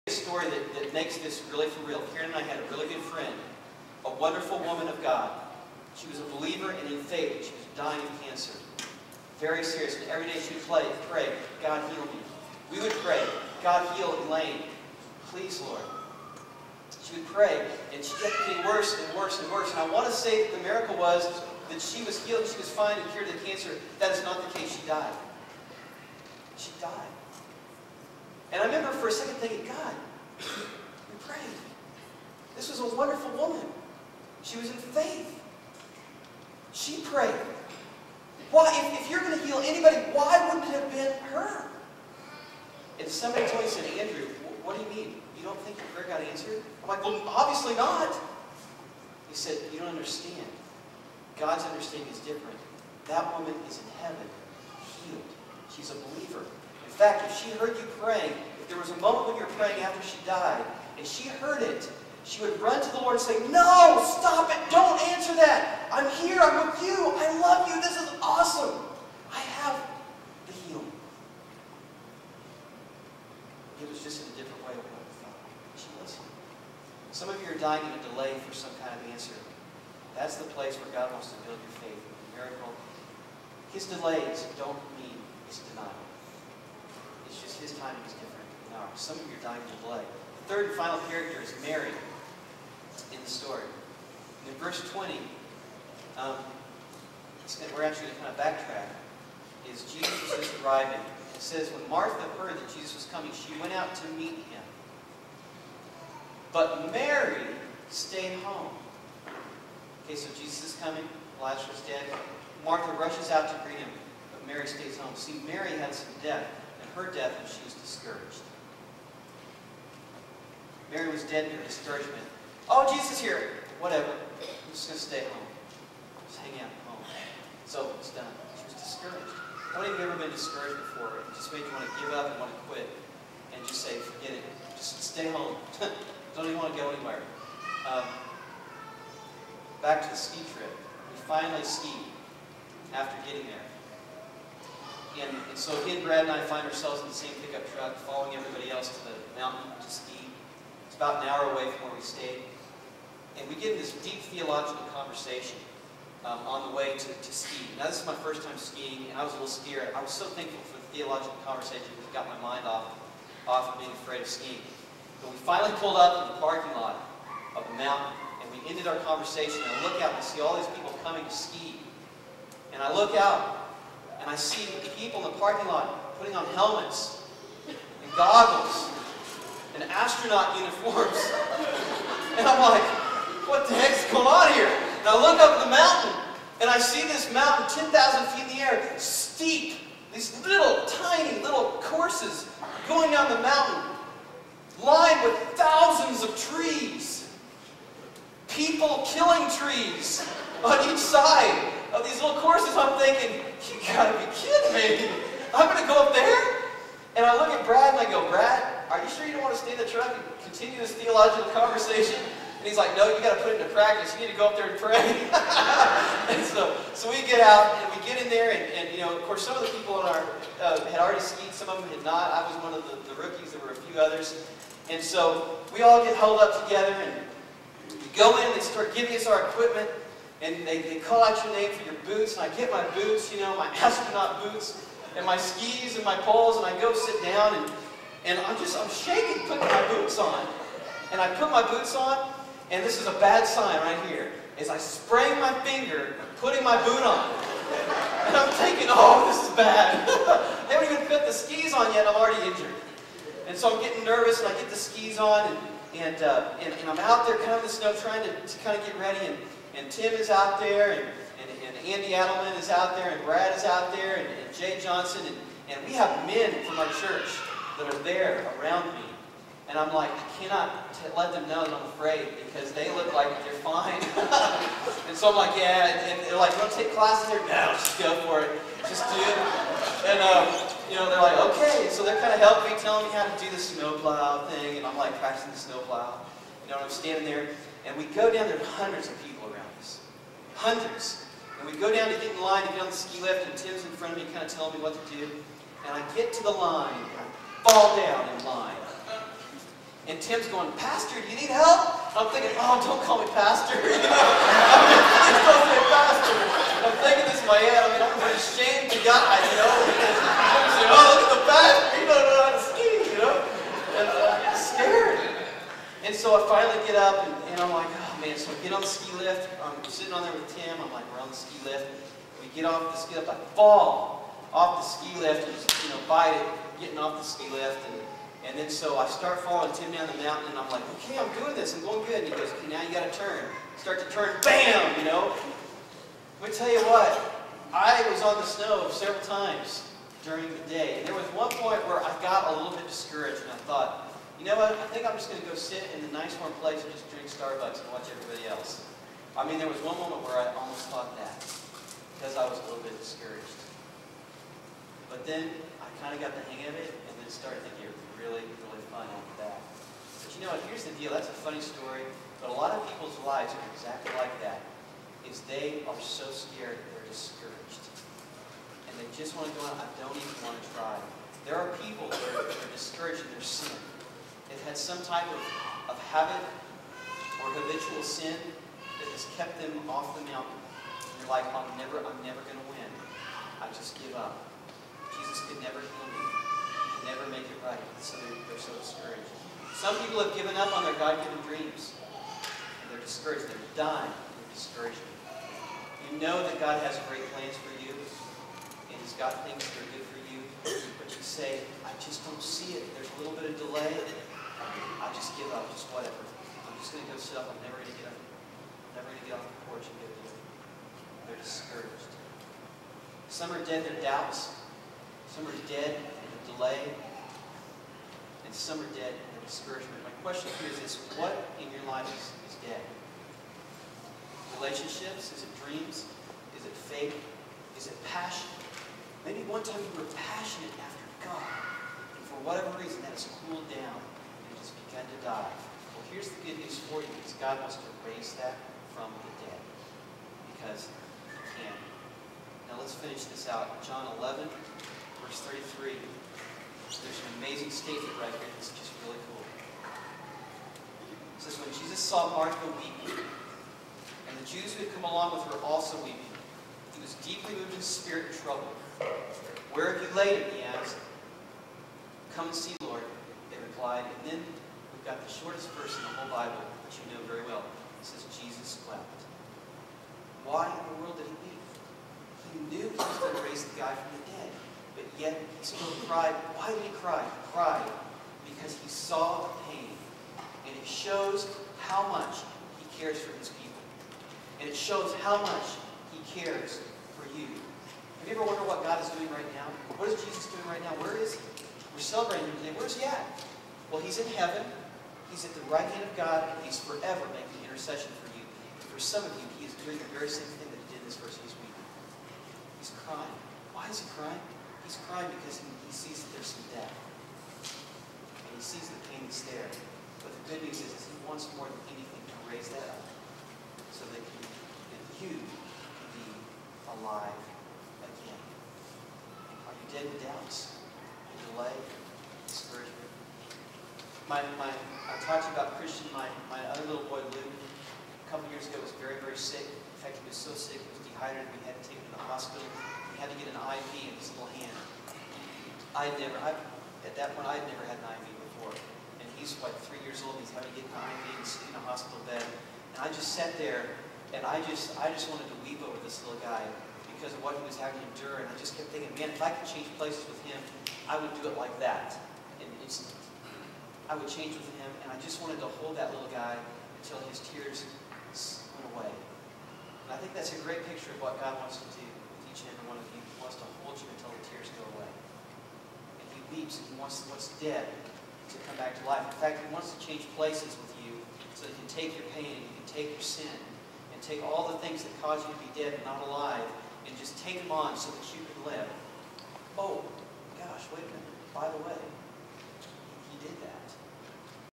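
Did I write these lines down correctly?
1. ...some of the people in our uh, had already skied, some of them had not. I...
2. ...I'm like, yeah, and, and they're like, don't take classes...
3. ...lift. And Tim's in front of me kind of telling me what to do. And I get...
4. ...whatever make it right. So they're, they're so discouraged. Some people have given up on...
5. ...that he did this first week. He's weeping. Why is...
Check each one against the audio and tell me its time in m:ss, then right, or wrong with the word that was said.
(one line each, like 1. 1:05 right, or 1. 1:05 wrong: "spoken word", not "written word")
1. 3:39 right
2. 4:35 right
3. 4:53 right
4. 6:27 wrong: "never", not "whatever"
5. 8:20 wrong: "crying", not "weeping".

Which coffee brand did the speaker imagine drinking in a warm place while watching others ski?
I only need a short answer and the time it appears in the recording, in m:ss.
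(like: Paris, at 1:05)
Starbucks, at 5:47.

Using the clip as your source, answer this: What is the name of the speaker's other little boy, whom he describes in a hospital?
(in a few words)
Luke.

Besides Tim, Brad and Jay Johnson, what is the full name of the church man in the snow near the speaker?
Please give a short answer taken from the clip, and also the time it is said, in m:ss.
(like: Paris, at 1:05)
Andy Adelman, at 4:21.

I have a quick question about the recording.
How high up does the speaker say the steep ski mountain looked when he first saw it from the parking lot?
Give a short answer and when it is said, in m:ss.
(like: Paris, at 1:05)
10,000 feet, at 3:07.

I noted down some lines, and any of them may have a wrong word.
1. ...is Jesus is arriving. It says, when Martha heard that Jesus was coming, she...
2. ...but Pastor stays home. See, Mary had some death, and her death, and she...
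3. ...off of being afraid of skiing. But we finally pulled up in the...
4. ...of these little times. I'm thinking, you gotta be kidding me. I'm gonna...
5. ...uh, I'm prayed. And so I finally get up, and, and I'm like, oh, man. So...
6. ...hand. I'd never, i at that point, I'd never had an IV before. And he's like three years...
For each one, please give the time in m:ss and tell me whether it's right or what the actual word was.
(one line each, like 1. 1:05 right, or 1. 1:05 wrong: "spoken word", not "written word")
1. 1:39 right
2. 1:54 wrong: "Mary", not "Pastor"
3. 2:43 right
4. 3:21 wrong: "courses", not "times"
5. 5:14 wrong: "scared", not "prayed"
6. 8:54 right.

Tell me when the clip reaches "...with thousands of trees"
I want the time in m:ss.
3:15.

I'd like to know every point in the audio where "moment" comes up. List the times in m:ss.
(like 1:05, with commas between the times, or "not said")
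0:59, 5:50.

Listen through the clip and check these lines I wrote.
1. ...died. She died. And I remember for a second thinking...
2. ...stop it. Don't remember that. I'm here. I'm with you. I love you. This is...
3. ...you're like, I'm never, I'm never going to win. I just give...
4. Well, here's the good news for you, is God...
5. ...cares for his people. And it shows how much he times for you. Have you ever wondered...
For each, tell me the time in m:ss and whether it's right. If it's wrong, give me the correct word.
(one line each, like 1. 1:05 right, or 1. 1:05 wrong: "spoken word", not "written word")
1. 0:24 right
2. 1:04 wrong: "answer", not "remember"
3. 6:21 right
4. 7:15 right
5. 8:02 wrong: "cares", not "times".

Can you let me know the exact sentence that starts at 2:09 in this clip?
How many of you ever been discouraged before?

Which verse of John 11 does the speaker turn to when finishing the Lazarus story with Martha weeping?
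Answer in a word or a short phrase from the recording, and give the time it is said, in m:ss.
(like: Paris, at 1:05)
33, at 7:25.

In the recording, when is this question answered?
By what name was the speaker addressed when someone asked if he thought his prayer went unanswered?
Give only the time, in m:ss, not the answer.
0:43.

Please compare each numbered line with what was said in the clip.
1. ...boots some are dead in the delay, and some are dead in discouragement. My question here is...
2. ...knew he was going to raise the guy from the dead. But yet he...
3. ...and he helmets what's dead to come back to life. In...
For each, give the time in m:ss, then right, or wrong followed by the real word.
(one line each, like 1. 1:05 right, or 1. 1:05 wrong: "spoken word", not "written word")
1. 6:54 wrong: "doubts", not "boots"
2. 7:52 right
3. 9:26 wrong: "wants", not "helmets".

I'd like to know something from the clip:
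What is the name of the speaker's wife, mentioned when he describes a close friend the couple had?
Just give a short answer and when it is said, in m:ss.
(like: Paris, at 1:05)
Karen, at 0:02.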